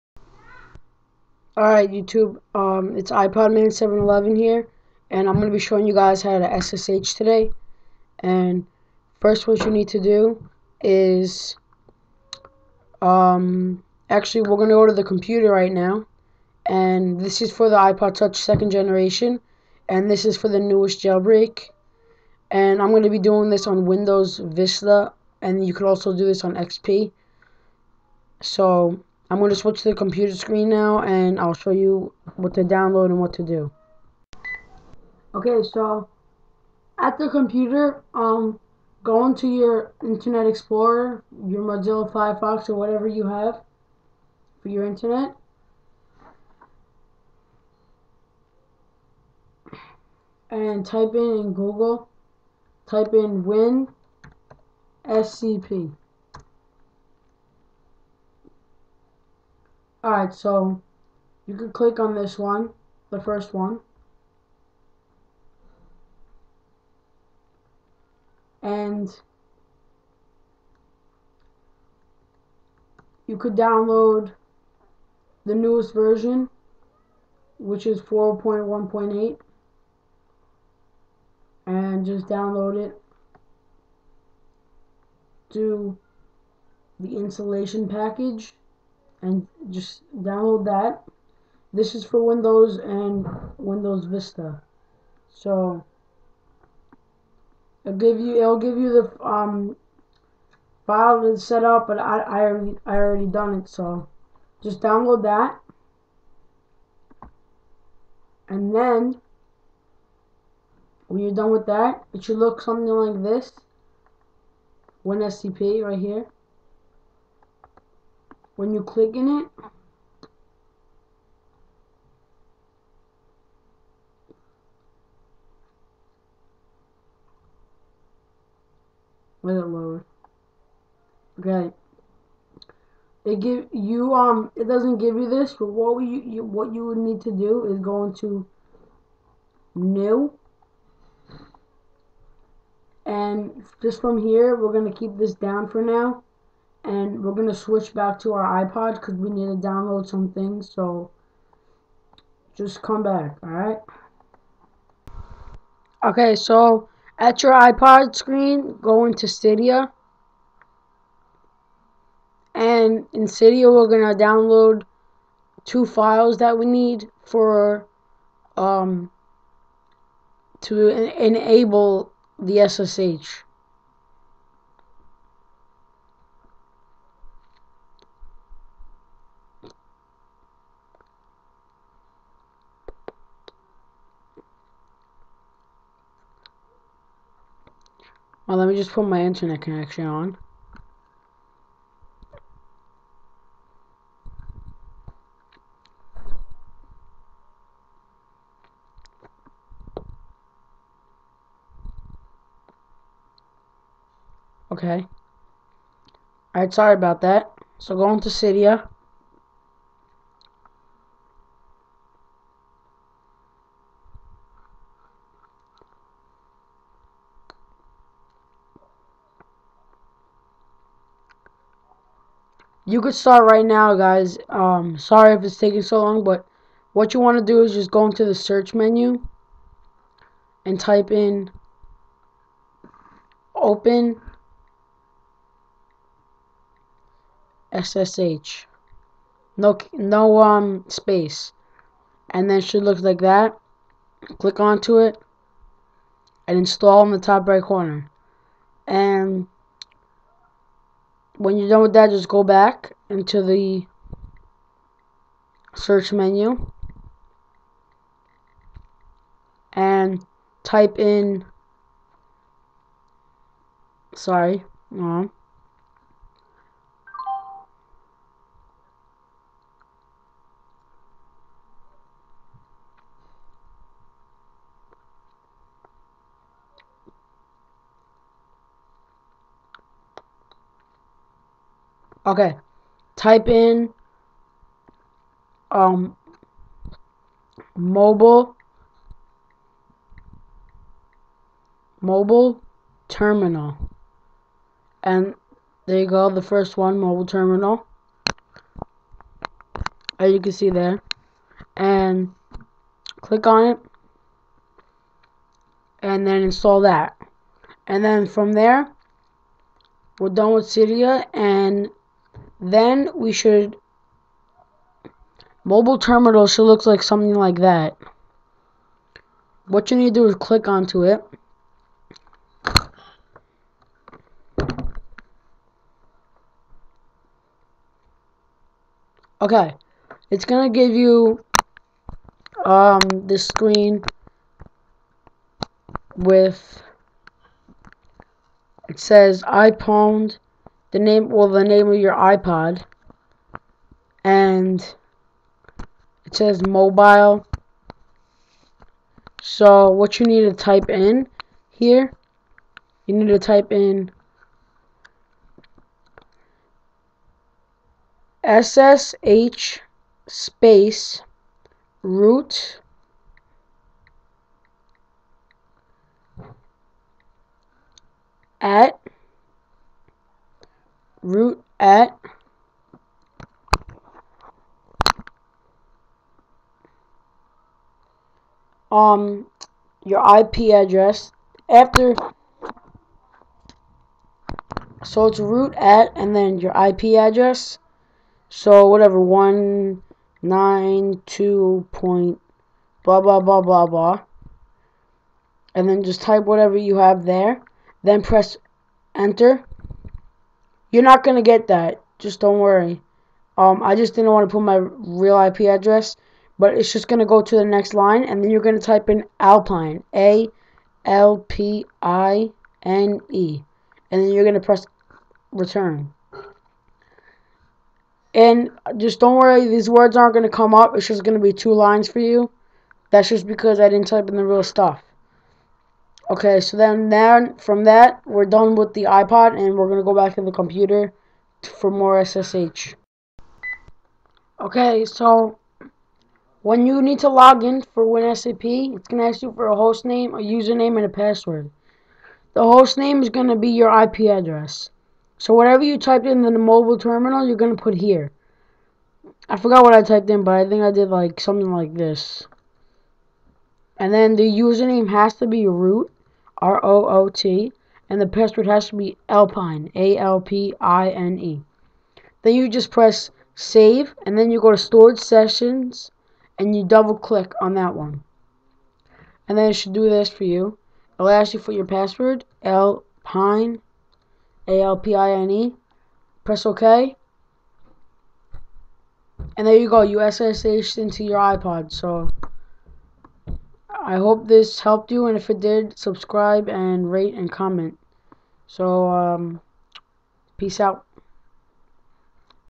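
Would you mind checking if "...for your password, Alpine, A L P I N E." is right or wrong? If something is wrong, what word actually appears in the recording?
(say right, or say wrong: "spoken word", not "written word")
right.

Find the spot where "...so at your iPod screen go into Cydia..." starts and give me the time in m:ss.
2:36.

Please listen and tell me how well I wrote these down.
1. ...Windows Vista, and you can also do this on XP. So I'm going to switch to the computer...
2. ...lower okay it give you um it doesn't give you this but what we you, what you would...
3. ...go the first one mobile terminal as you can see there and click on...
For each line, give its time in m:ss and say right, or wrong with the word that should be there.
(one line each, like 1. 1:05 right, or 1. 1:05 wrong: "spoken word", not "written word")
1. 0:23 right
2. 2:09 right
3. 4:56 right.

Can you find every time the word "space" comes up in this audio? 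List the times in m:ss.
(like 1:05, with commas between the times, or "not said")
4:00, 6:00.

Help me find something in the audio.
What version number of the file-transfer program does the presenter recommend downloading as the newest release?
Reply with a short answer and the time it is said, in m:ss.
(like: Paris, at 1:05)
4.1.8, at 1:18.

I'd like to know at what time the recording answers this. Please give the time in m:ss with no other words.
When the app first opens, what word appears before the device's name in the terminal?
5:39.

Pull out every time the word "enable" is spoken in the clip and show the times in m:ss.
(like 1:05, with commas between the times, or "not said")
2:51.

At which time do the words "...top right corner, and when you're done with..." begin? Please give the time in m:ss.
4:07.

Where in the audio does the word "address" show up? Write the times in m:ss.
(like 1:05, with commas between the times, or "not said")
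6:20, 6:27, 6:45, 7:24.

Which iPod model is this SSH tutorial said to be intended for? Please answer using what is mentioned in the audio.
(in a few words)
iPod Touch second generation.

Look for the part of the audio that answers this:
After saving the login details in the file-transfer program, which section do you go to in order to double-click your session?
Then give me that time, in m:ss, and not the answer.
7:44.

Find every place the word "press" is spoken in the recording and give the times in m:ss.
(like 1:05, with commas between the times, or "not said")
6:38, 6:54, 7:42, 7:56.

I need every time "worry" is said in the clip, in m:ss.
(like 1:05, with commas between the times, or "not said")
6:42, 6:59.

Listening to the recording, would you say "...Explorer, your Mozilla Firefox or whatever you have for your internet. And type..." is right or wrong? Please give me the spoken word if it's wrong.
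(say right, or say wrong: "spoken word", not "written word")
right.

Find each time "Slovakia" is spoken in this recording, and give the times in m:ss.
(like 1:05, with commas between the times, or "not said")
not said.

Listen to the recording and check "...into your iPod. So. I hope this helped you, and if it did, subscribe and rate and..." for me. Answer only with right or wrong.
right.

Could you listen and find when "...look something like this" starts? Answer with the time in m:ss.
1:52.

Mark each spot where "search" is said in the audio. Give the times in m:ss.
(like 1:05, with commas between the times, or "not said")
3:48, 4:15.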